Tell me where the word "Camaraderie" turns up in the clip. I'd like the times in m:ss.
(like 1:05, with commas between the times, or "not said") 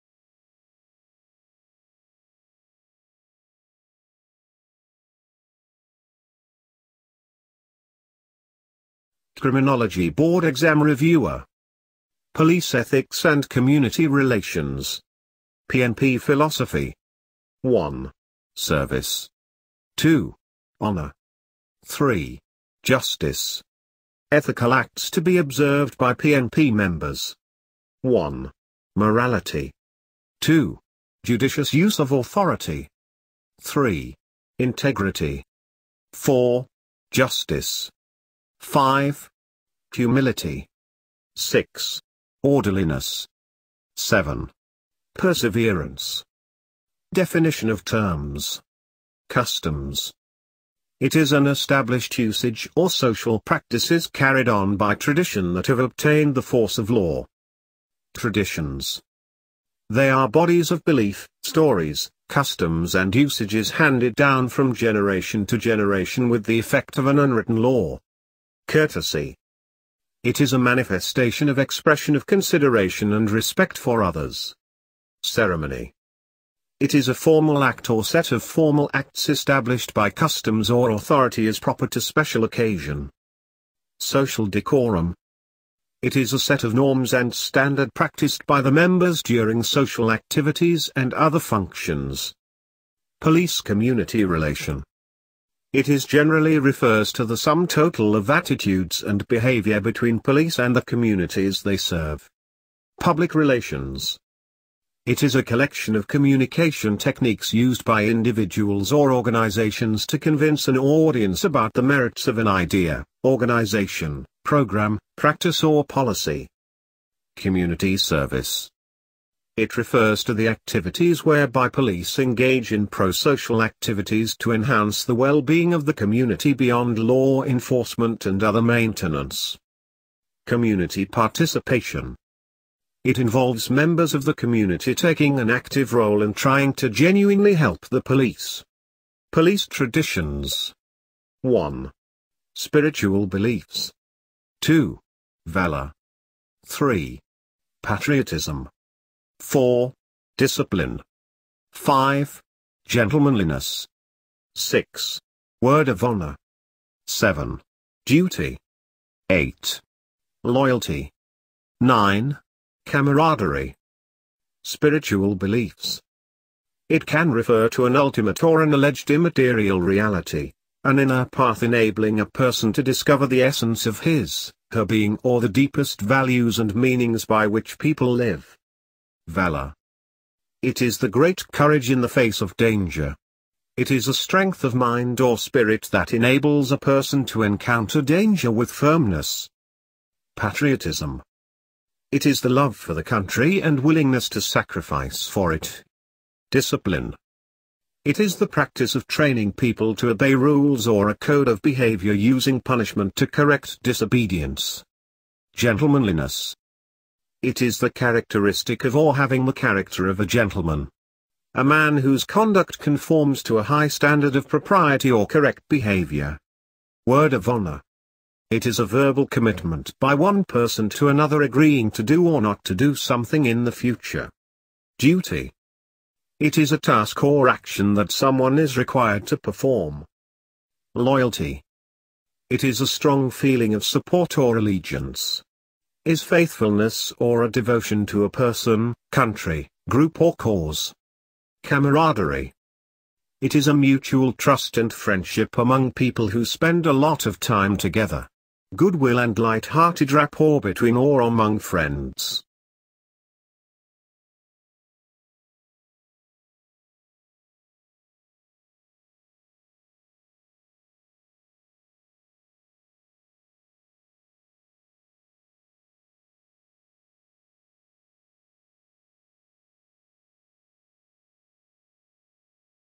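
2:42, 4:01.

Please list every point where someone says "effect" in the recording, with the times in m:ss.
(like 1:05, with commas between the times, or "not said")
1:06.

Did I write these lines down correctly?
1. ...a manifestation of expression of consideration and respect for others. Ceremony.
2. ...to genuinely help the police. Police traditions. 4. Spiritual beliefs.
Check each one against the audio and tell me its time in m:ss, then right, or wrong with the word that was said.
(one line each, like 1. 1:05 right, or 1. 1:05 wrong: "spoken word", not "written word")
1. 1:10 right
2. 2:16 wrong: "1", not "4".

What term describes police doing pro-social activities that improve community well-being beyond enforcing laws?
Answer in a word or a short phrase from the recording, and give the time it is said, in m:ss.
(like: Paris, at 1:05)
Community Service, at 1:57.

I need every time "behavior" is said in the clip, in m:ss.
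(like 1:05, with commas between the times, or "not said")
1:39, 3:21, 3:35.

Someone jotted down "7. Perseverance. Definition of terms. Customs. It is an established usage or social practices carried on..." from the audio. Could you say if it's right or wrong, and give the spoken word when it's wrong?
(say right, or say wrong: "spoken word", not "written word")
right.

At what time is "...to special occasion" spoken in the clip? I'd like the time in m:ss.
1:21.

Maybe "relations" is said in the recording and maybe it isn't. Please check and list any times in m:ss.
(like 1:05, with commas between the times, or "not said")
0:14, 1:34, 1:43.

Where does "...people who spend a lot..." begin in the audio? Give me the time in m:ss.
4:05.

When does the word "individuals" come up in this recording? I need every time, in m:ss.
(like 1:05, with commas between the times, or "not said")
1:48.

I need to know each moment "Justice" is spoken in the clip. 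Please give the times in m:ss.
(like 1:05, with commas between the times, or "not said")
0:22, 0:37.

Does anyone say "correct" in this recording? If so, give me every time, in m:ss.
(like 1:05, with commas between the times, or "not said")
3:23, 3:35.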